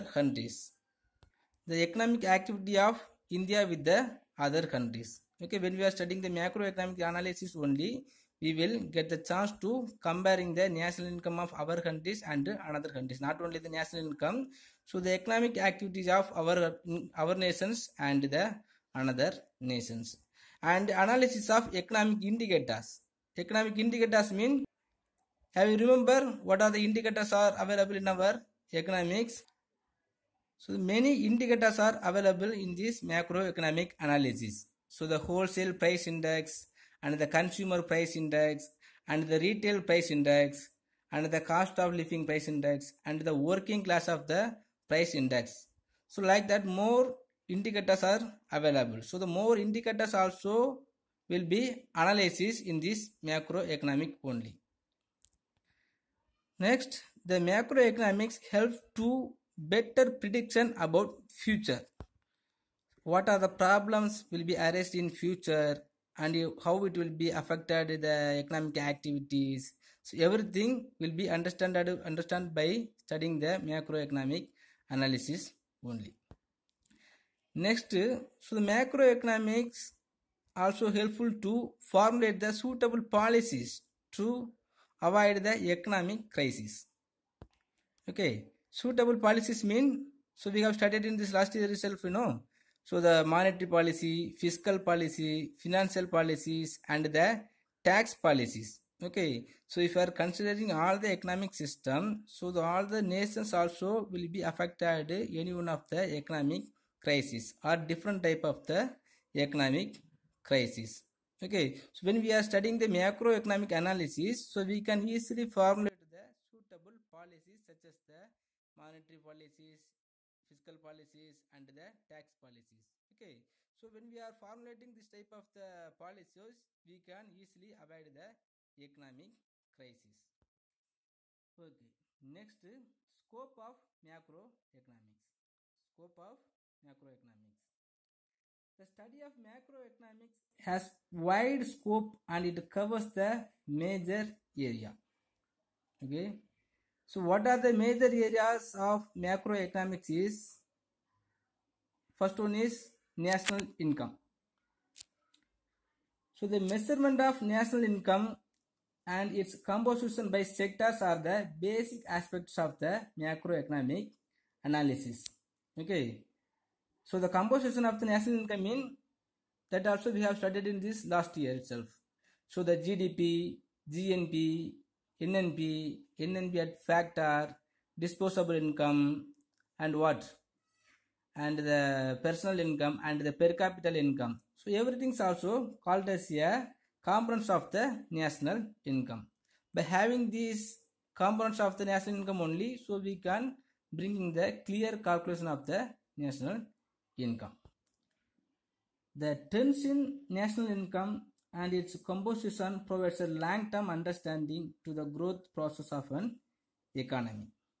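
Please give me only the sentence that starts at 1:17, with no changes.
Next, so the macroeconomics also helpful to formulate the suitable policies to avoid the economic crisis.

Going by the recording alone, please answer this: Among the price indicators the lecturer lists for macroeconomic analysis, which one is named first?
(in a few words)
Wholesale price index.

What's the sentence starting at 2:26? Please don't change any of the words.
Okay, so what are the major areas of macroeconomics is first one is national income.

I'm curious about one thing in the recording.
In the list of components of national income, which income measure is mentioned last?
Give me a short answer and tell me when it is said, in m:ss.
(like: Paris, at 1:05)
Per capita income, at 3:03.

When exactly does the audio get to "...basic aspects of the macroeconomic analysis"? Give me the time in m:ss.
2:41.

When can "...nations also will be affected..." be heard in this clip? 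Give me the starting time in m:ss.
1:43.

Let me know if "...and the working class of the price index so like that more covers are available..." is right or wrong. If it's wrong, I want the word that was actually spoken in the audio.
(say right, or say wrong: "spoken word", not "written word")
wrong: "indicators", not "covers".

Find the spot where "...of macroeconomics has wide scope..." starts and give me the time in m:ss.
2:19.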